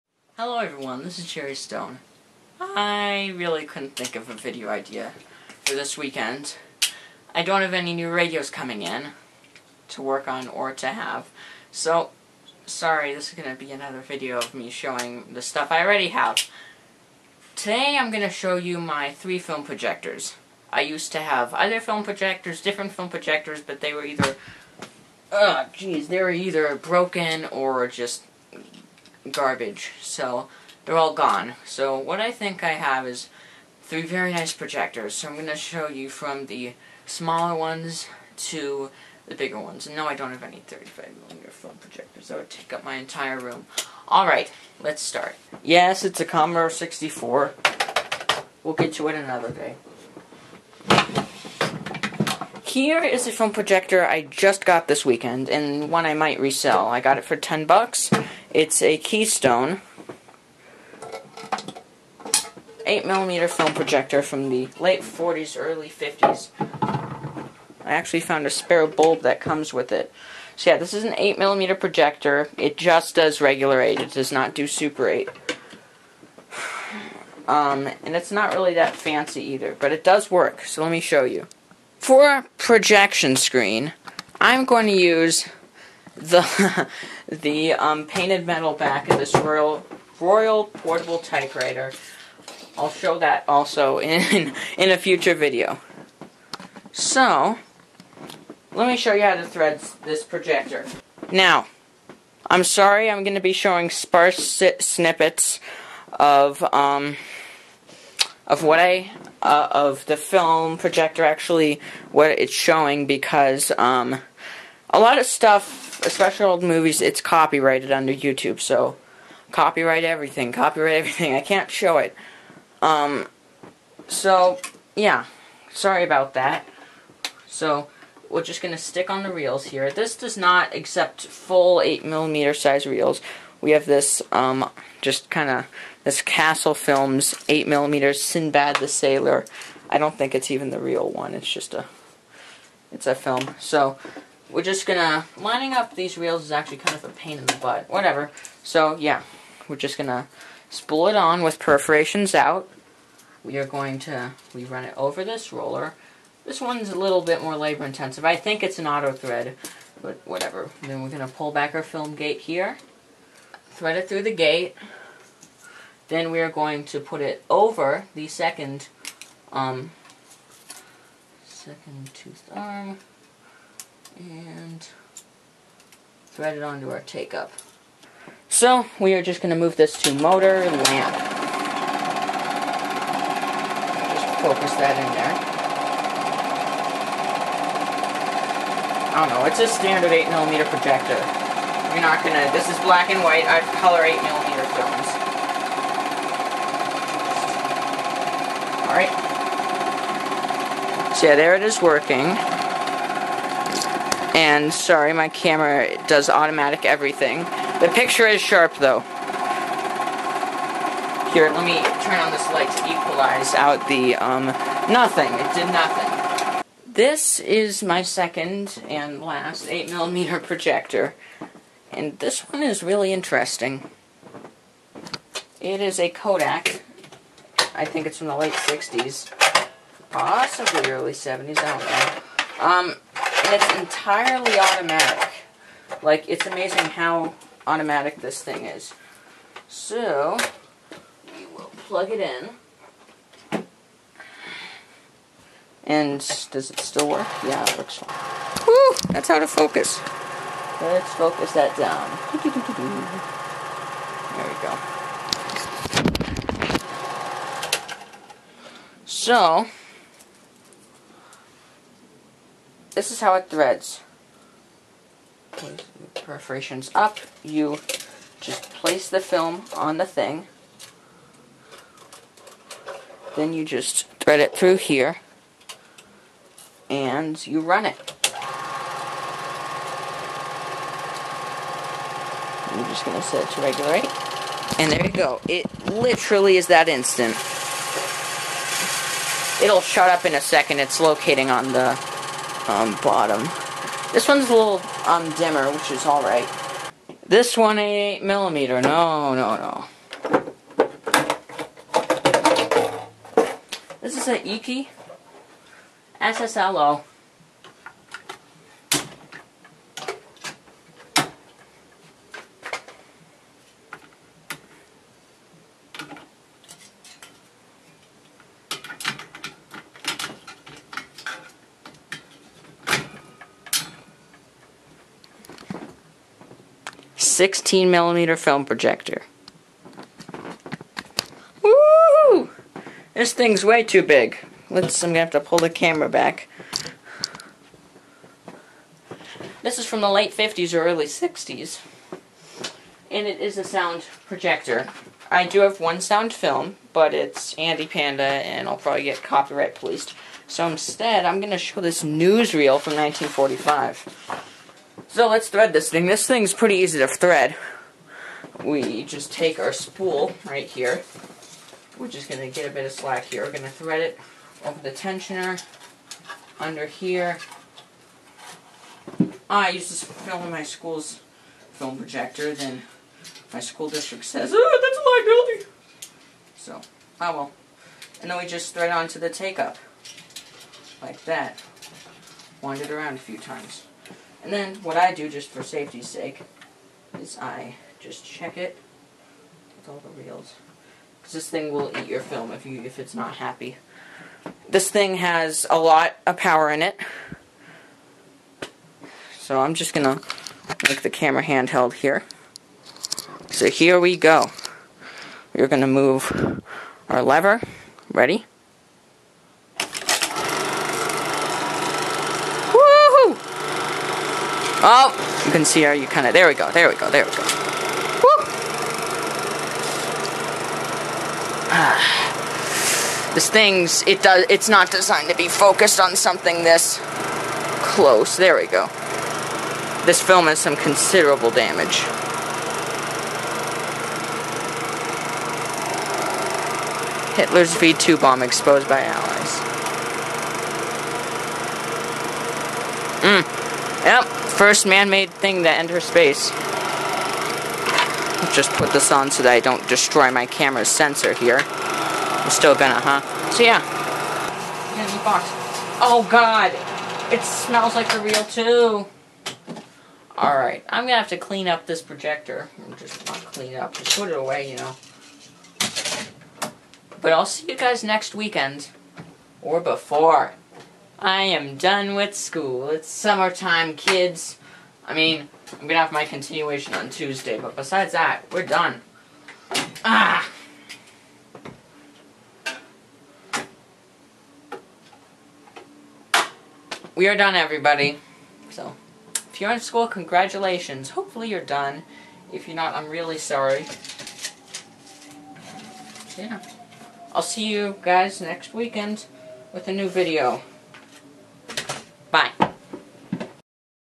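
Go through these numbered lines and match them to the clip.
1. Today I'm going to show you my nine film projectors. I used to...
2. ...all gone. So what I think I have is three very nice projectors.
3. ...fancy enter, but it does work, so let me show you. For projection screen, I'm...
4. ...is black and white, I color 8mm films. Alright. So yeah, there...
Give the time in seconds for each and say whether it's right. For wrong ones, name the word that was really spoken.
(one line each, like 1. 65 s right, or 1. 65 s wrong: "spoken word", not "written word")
1. 17 s wrong: "three", not "nine"
2. 30 s right
3. 78 s wrong: "either", not "enter"
4. 192 s right.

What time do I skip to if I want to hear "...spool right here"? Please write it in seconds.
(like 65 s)
359 s.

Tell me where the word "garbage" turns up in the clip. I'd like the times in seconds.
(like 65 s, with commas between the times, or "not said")
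29 s.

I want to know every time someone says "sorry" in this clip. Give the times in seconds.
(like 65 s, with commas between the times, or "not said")
12 s, 102 s, 125 s, 204 s, 493 s.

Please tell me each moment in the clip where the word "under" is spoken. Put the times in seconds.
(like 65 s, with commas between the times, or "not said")
117 s, 366 s.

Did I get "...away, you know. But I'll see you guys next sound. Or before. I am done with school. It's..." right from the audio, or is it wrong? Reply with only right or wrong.
wrong.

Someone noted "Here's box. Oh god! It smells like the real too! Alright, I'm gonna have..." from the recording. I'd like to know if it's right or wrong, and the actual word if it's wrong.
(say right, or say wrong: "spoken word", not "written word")
right.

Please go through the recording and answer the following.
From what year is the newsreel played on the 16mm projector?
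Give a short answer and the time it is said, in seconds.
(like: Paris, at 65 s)
1945, at 352 s.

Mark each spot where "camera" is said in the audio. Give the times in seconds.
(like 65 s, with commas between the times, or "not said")
205 s, 335 s, 401 s, 450 s.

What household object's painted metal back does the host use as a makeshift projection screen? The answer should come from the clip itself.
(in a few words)
Royal Portable Typewriter.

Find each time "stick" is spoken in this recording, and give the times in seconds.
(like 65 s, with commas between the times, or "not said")
128 s.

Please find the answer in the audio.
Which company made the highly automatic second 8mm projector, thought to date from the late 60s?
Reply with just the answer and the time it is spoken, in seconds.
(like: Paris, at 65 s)
Kodak, at 226 s.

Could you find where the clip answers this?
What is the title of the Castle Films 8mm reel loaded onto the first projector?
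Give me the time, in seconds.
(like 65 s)
138 s.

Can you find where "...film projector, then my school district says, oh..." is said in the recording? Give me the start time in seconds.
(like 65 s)
371 s.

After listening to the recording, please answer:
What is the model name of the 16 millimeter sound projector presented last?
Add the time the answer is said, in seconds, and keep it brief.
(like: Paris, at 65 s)
Eiki SSLO, at 304 s.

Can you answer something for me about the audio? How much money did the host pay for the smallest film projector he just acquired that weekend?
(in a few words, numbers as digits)
$10.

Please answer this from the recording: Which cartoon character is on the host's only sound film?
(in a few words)
Andy Panda.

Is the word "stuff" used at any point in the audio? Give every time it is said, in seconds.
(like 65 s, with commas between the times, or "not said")
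15 s, 115 s.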